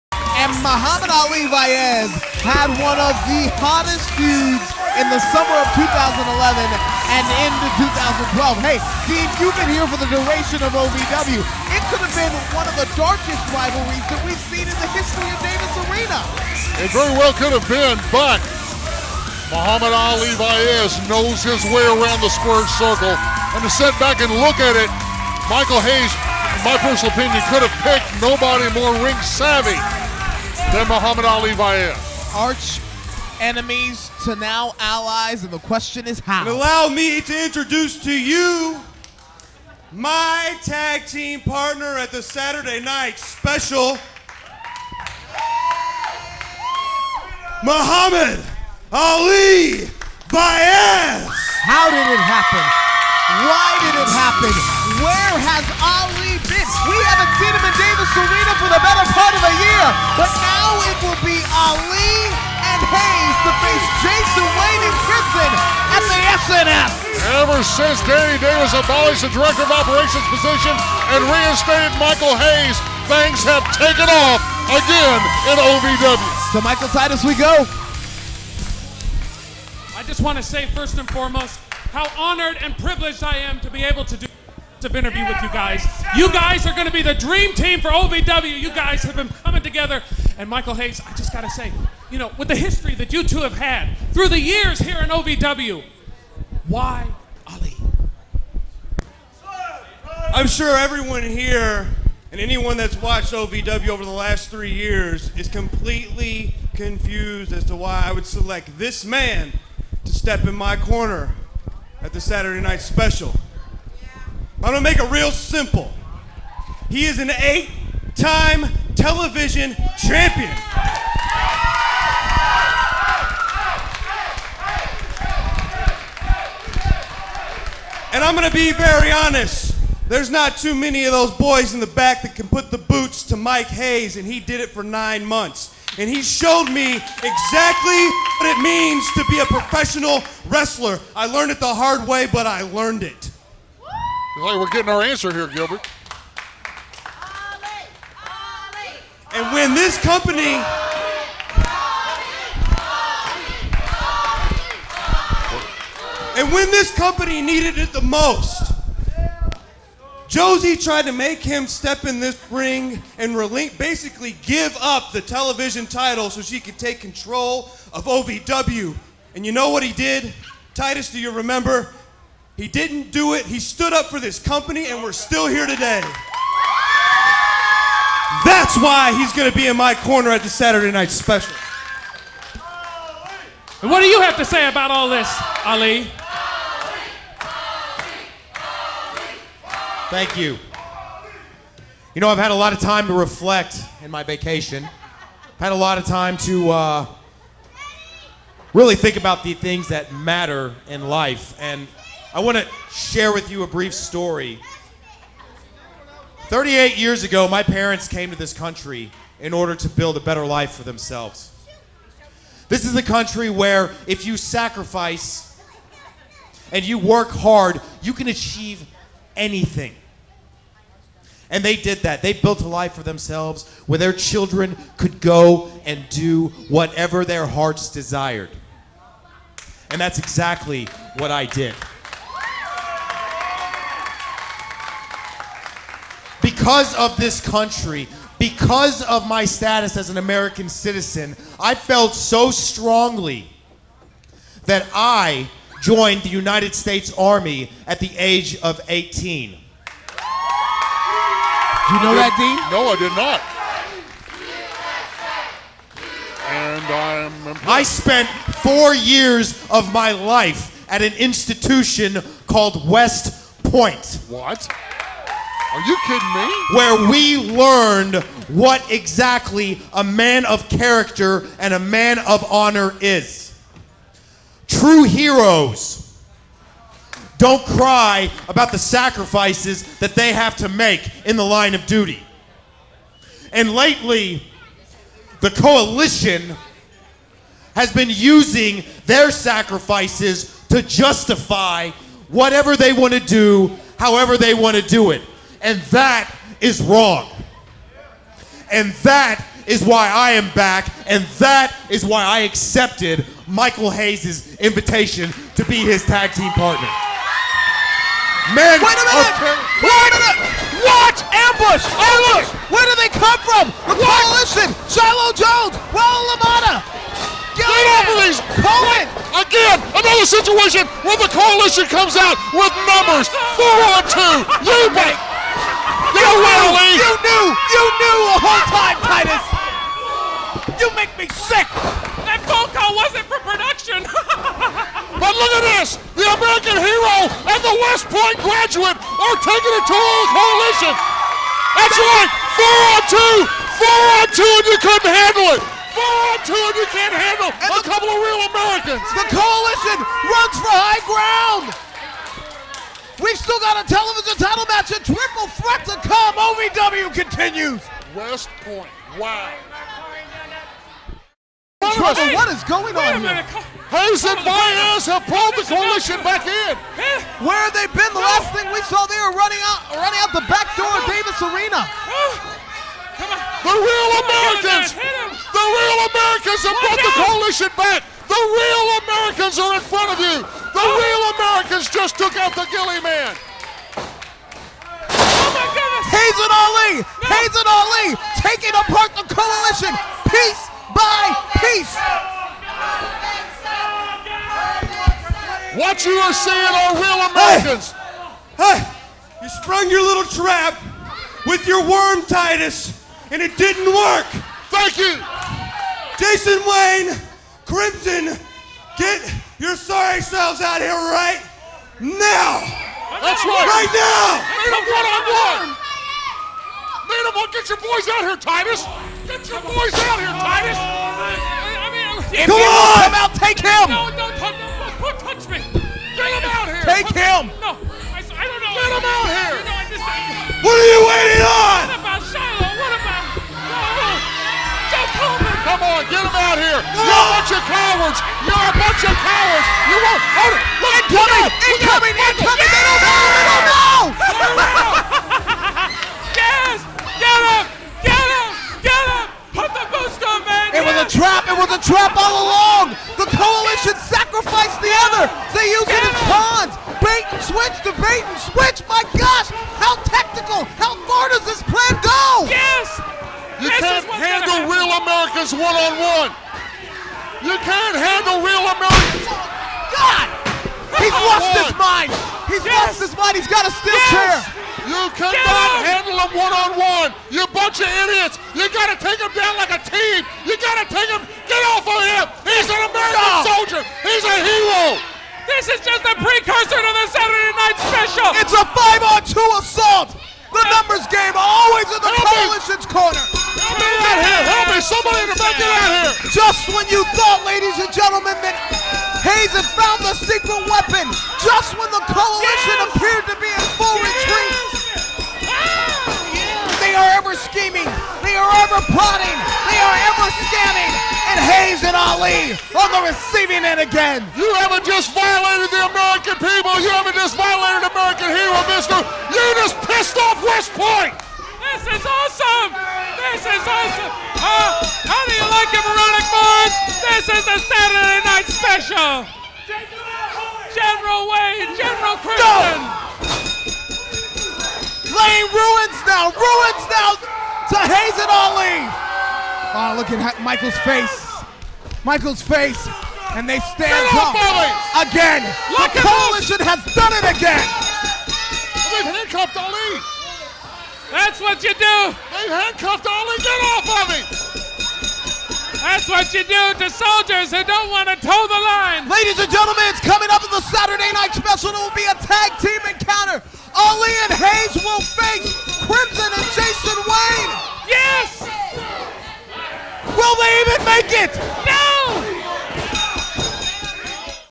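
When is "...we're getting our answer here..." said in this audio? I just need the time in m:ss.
2:24.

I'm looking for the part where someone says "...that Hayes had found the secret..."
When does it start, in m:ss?
8:18.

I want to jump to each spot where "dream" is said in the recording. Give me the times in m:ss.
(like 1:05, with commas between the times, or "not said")
1:27.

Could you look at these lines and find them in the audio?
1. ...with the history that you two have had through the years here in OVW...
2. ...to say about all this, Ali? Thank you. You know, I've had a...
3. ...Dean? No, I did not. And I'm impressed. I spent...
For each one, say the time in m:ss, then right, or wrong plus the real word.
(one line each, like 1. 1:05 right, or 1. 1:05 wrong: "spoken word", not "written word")
1. 1:32 right
2. 3:04 right
3. 4:12 right.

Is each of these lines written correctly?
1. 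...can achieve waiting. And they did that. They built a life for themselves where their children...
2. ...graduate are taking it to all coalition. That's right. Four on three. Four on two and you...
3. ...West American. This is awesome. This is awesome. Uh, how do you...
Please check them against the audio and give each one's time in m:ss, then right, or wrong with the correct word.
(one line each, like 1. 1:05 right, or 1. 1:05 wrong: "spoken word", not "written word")
1. 3:38 wrong: "anything", not "waiting"
2. 5:38 wrong: "two", not "three"
3. 8:40 wrong: "Point", not "American".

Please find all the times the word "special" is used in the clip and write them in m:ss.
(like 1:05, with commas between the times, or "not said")
0:43, 1:52, 3:01, 8:07, 8:48, 9:21.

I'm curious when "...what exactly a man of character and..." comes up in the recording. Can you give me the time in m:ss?
4:28.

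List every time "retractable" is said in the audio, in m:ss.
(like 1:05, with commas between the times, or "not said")
not said.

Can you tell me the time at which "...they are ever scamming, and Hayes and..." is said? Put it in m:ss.
8:29.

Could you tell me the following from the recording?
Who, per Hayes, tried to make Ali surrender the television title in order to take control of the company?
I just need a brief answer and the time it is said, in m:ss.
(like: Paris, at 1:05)
Josie, at 2:40.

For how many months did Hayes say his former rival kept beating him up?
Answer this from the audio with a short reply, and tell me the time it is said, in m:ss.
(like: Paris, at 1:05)
9, at 2:14.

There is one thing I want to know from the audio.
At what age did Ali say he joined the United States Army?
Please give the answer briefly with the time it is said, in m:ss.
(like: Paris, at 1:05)
18, at 4:08.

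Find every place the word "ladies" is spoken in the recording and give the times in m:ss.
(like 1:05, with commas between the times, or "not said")
8:17, 9:19.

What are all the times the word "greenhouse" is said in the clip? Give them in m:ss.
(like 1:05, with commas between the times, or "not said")
not said.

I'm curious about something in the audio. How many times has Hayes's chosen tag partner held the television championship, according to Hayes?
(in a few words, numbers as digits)
8.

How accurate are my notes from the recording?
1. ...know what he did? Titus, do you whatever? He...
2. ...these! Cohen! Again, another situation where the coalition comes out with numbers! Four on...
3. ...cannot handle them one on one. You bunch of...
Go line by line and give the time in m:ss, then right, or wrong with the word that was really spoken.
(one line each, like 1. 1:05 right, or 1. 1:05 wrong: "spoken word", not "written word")
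1. 2:49 wrong: "remember", not "whatever"
2. 5:18 right
3. 7:55 right.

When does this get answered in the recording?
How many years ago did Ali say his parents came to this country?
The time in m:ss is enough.
3:26.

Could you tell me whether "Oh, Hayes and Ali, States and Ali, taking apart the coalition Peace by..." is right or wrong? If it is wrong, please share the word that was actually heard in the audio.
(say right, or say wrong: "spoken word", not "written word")
wrong: "Hayes", not "States".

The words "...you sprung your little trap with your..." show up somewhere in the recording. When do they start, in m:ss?
6:39.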